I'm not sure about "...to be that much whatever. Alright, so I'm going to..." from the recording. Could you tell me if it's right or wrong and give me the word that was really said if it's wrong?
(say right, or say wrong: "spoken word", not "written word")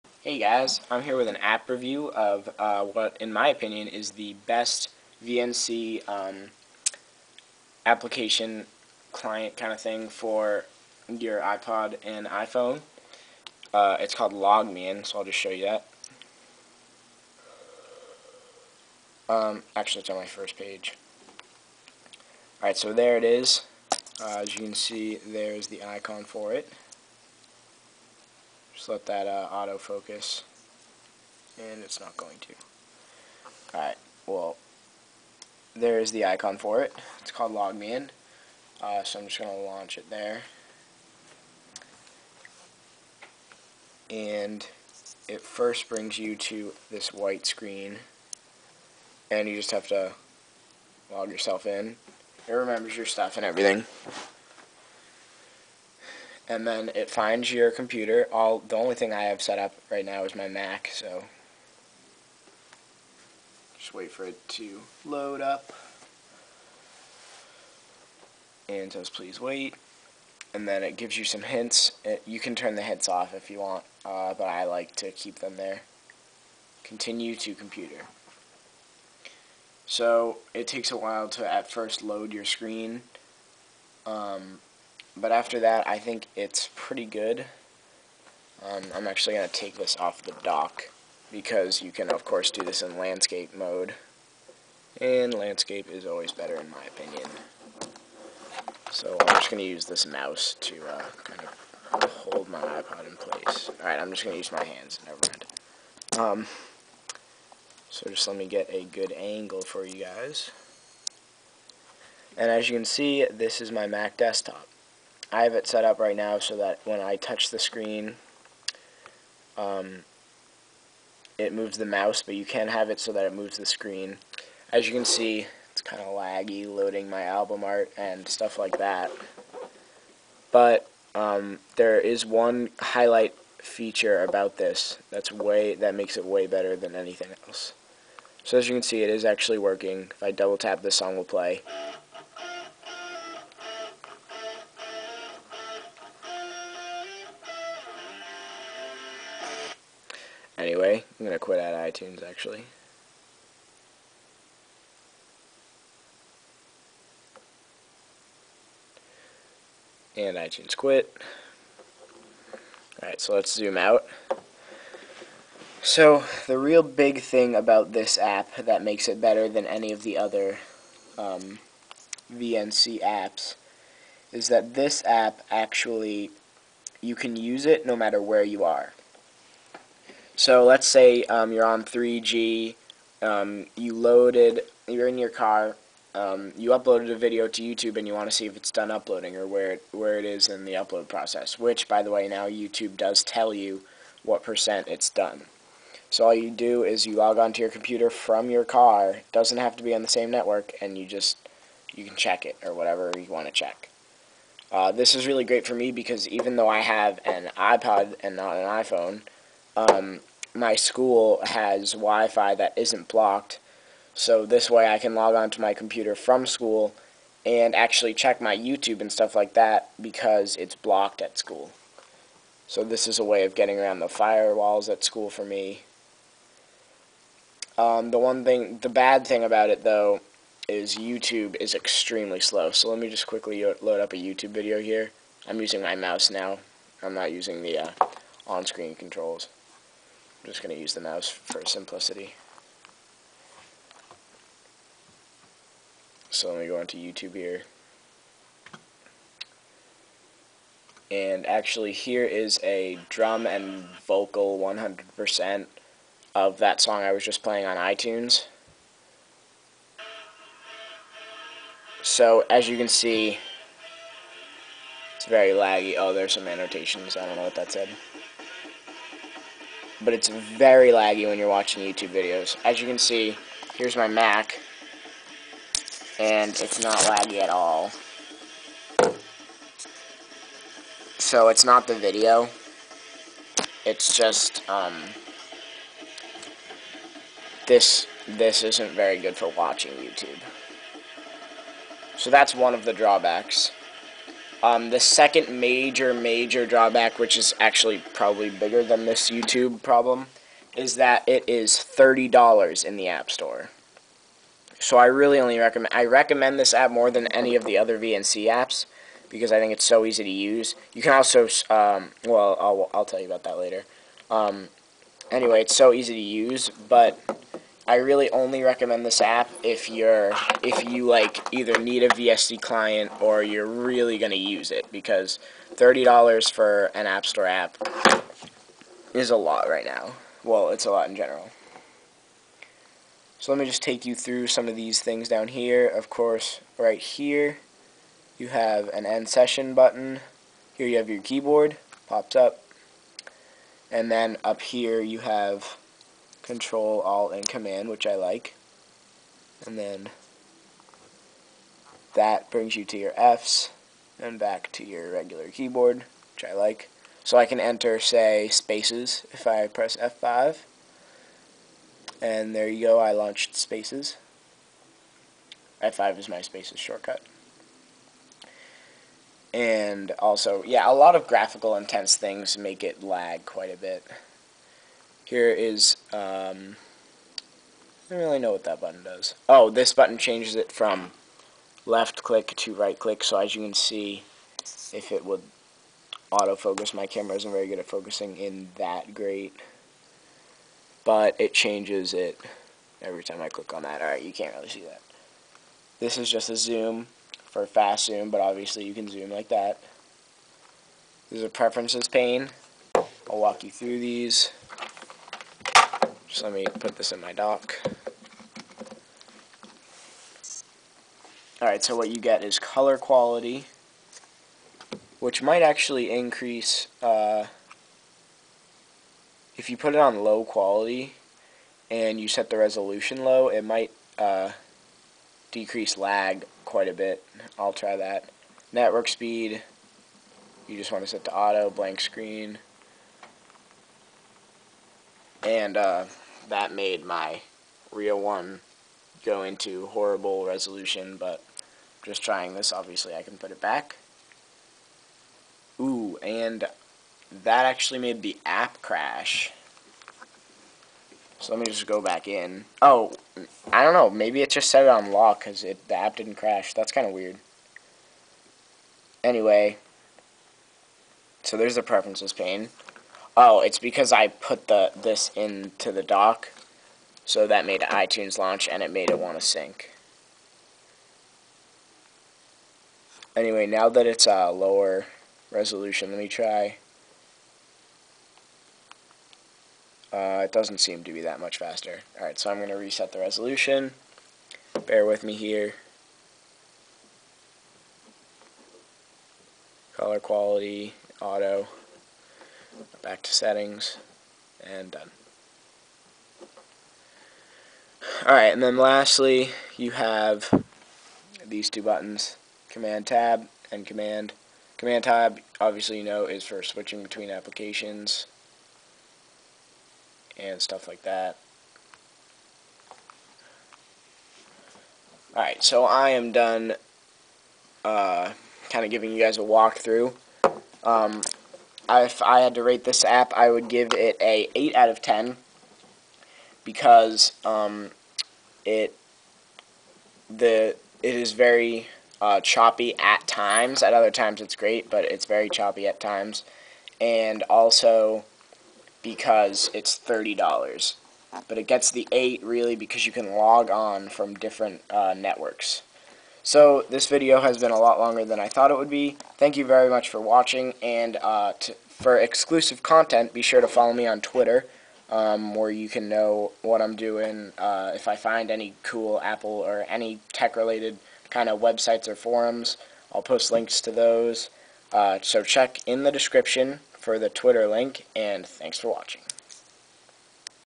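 wrong: "faster", not "whatever".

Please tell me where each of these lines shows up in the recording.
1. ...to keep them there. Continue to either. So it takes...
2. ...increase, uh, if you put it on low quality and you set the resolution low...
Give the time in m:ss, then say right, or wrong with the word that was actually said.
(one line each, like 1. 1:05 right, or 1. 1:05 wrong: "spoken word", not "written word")
1. 1:14 wrong: "computer", not "either"
2. 6:56 right.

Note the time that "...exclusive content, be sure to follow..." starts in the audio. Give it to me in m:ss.
9:12.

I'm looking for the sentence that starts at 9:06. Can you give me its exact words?
So this video has been a lot longer than I thought it would be.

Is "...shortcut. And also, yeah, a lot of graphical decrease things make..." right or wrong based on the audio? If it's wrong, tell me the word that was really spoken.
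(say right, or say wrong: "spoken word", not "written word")
wrong: "intense", not "decrease".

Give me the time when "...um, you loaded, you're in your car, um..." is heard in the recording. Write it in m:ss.
3:03.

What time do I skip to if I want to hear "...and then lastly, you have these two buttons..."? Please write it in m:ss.
8:18.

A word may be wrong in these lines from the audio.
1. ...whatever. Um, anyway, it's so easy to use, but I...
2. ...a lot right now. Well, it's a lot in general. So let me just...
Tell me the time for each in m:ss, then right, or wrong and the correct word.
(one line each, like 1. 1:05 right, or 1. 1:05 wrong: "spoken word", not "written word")
1. 5:13 wrong: "later", not "whatever"
2. 5:29 right.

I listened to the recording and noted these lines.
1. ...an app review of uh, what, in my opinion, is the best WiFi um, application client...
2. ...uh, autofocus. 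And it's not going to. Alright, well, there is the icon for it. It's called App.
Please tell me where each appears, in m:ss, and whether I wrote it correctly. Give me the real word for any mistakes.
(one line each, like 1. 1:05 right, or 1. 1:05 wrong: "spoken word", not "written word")
1. 0:01 wrong: "VNC", not "WiFi"
2. 0:29 wrong: "LogMeIn", not "App".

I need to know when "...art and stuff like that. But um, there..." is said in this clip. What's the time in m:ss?
2:07.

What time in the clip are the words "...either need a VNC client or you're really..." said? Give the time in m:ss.
5:21.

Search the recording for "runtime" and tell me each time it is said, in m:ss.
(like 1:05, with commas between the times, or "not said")
not said.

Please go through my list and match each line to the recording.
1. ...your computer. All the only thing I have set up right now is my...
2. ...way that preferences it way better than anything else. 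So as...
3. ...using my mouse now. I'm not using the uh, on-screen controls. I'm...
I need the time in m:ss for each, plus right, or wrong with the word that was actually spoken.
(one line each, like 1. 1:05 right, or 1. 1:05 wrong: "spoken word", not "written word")
1. 0:57 right
2. 2:15 wrong: "makes", not "preferences"
3. 3:55 right.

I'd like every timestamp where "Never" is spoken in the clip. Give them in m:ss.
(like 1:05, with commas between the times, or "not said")
1:45.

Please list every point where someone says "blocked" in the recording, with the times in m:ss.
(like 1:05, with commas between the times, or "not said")
3:33, 3:40.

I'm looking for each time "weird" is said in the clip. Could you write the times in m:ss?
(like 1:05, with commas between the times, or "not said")
7:37.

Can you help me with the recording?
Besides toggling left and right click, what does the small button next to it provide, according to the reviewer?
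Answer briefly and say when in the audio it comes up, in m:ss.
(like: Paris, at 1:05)
fast zoom, at 6:37.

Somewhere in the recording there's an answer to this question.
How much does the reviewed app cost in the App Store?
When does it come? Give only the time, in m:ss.
5:01.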